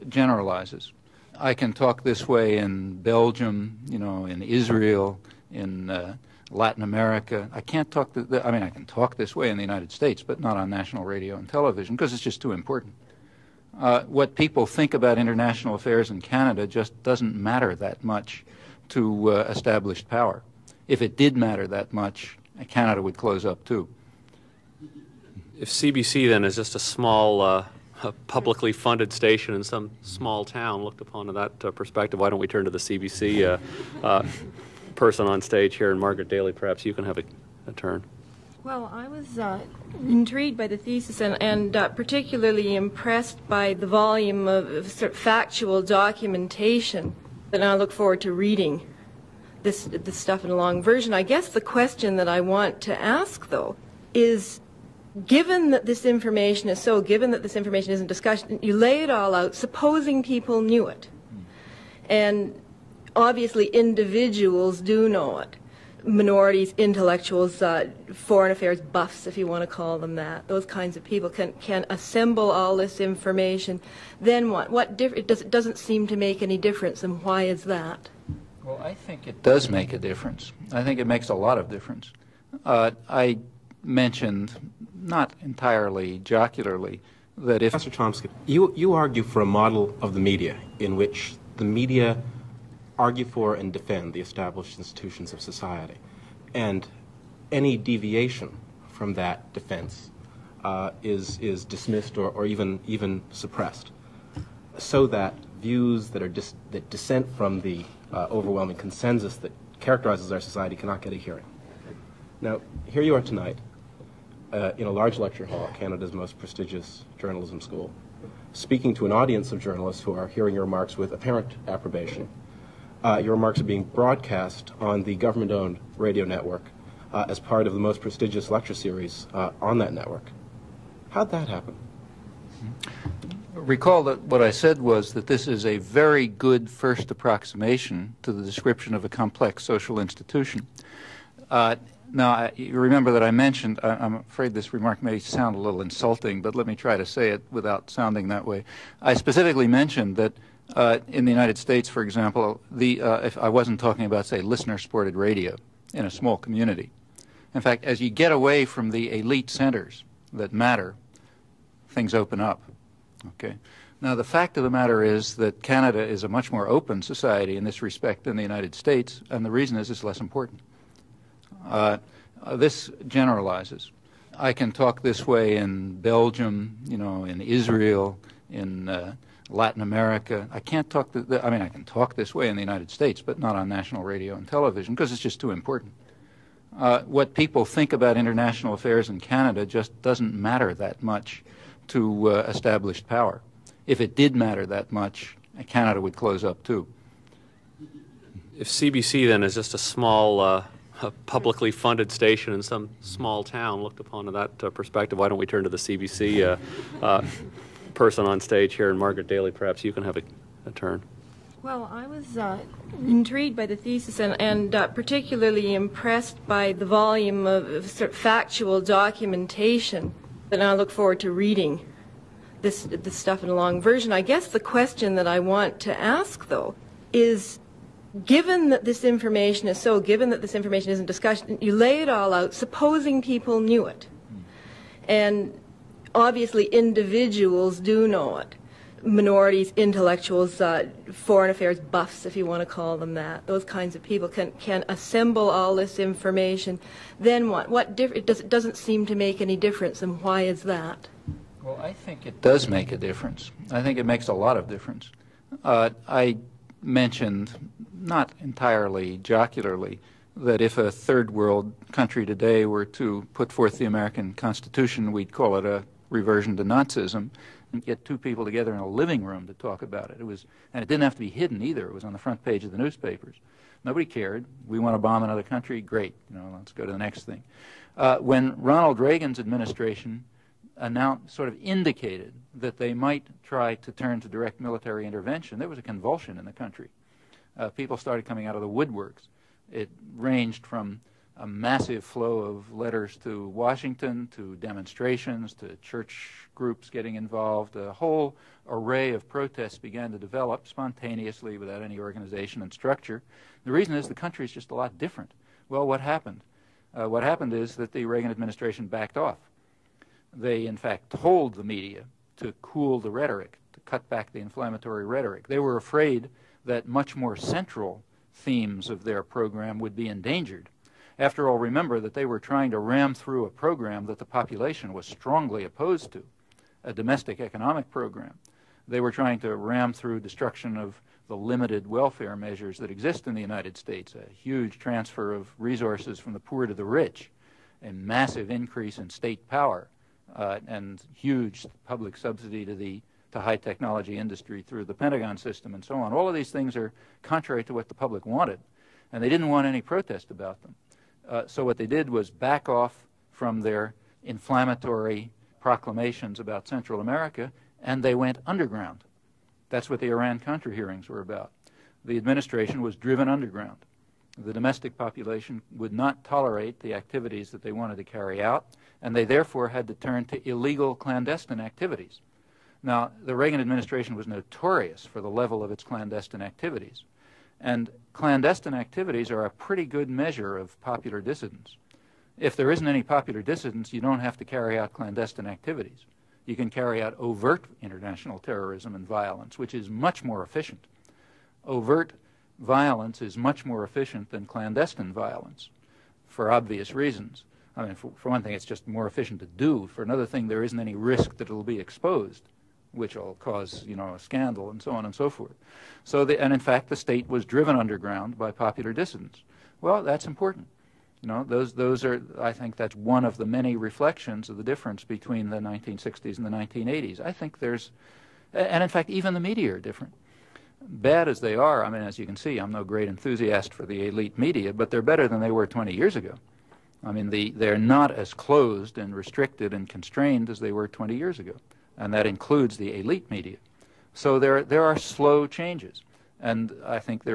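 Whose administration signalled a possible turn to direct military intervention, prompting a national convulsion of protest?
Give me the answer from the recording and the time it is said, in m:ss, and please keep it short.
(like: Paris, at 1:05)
Ronald Reagan, at 4:38.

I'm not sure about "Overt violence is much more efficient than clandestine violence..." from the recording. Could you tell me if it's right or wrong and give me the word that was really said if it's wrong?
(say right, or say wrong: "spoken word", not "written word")
right.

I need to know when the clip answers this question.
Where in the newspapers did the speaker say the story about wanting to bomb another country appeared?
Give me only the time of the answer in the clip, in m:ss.
4:32.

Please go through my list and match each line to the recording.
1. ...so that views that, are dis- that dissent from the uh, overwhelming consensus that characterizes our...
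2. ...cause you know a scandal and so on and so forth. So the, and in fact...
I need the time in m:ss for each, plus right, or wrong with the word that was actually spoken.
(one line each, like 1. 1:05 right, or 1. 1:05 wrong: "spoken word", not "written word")
1. 1:44 right
2. 6:43 right.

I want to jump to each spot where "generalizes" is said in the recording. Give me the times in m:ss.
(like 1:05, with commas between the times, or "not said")
0:00, 2:53.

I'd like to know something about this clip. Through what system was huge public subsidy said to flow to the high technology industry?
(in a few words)
Pentagon system.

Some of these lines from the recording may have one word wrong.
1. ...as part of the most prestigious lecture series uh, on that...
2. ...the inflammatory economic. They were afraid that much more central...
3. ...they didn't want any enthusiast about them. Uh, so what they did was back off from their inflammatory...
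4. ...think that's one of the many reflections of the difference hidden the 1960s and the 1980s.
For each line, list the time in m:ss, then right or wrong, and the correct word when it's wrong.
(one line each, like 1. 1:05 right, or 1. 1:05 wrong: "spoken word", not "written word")
1. 2:07 right
2. 5:14 wrong: "rhetoric", not "economic"
3. 5:49 wrong: "protest", not "enthusiast"
4. 6:52 wrong: "between", not "hidden".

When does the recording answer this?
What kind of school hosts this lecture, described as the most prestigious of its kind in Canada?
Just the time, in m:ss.
1:57.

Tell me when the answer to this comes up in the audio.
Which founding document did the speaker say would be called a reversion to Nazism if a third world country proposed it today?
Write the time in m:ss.
4:23.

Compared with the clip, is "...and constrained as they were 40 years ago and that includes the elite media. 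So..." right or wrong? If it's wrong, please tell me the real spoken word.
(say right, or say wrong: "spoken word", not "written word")
wrong: "20", not "40".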